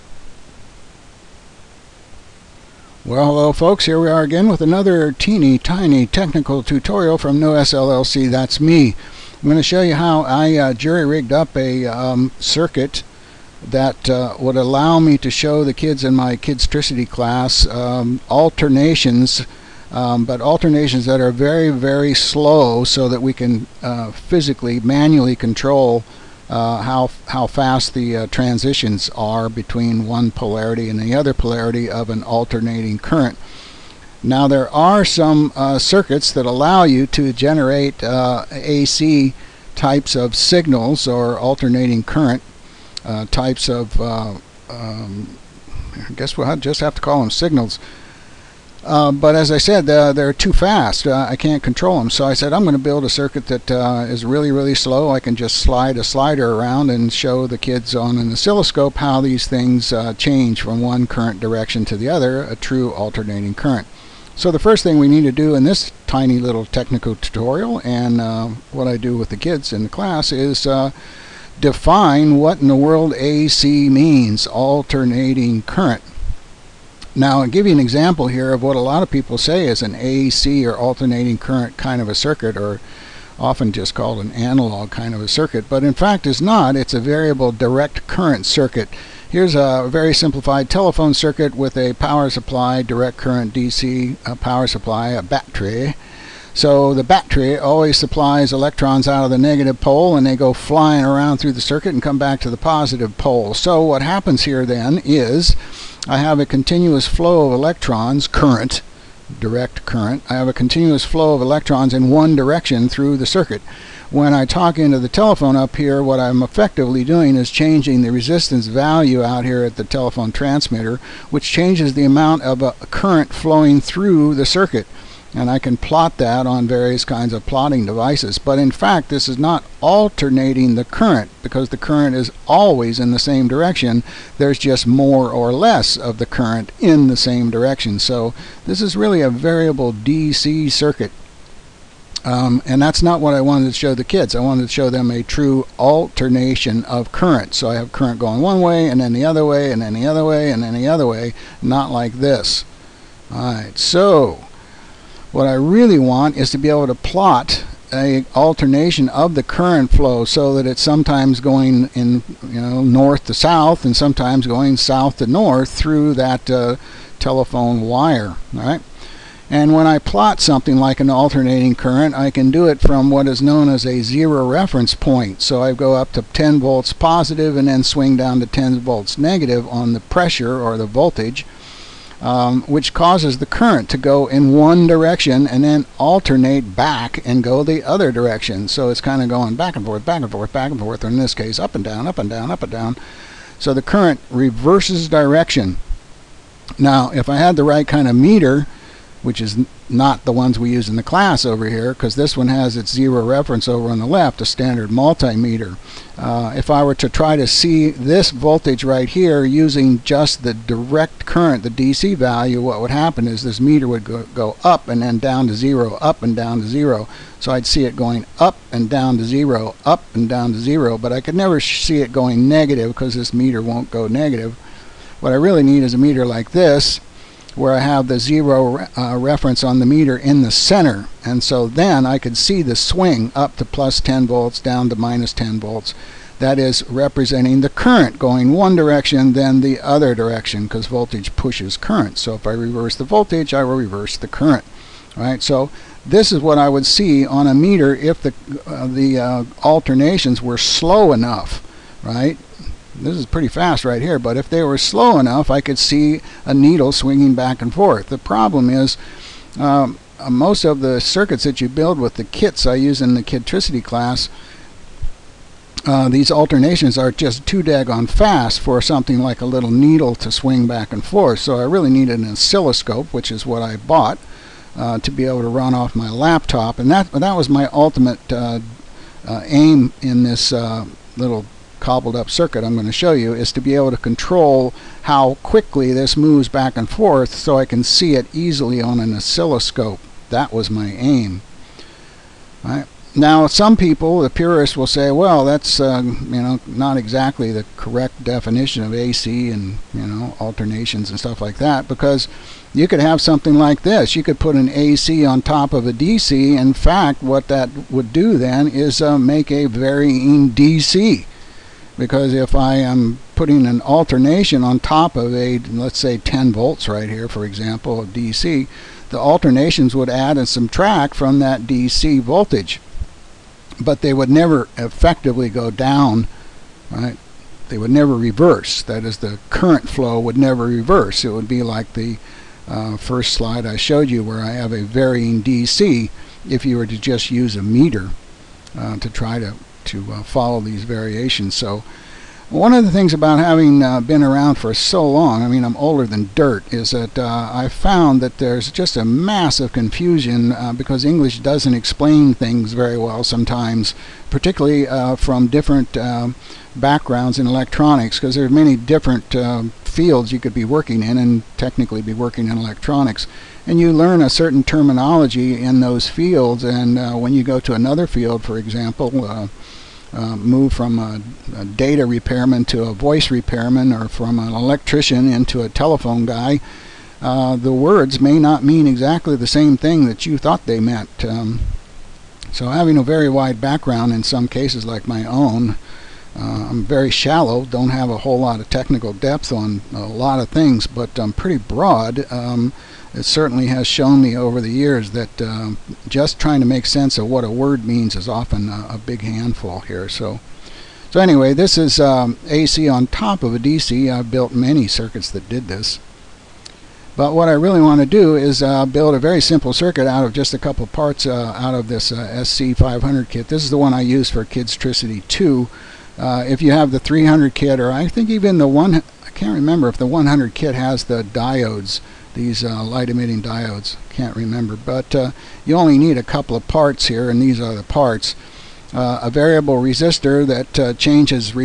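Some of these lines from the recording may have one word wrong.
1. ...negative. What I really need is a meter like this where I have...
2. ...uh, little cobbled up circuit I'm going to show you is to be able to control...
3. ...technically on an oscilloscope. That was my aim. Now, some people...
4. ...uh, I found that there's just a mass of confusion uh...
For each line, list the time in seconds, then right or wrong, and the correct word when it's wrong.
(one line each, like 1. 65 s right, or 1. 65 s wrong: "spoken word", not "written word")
1. 224 s right
2. 280 s right
3. 288 s wrong: "easily", not "technically"
4. 347 s right.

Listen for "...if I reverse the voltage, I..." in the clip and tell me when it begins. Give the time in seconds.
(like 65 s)
242 s.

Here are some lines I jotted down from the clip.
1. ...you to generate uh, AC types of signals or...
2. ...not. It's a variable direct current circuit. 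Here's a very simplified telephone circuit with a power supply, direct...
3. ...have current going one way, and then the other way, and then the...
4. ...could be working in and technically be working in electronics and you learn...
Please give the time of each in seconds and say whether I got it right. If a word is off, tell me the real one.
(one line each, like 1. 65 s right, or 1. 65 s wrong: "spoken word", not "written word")
1. 36 s right
2. 86 s right
3. 147 s right
4. 360 s right.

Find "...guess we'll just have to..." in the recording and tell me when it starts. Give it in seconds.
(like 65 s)
46 s.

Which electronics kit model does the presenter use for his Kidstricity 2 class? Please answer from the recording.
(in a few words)
SC500.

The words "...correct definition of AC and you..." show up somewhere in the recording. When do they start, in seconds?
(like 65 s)
297 s.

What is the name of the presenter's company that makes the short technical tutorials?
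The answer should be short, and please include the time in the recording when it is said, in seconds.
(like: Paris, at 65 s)
Noess LLC, at 7 s.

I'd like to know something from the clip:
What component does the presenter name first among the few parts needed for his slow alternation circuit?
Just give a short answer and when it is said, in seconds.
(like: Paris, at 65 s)
Variable resistor, at 429 s.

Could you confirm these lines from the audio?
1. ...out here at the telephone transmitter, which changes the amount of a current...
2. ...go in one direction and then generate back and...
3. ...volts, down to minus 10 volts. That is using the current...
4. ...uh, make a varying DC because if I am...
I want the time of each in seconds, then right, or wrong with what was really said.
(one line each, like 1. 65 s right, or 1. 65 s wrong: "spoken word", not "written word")
1. 119 s right
2. 183 s wrong: "alternate", not "generate"
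3. 234 s wrong: "representing", not "using"
4. 309 s right.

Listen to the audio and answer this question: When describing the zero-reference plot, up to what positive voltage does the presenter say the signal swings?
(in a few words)
10 volts.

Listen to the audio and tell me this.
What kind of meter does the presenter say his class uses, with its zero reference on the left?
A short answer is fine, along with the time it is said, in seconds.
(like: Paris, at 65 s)
Standard multimeter, at 204 s.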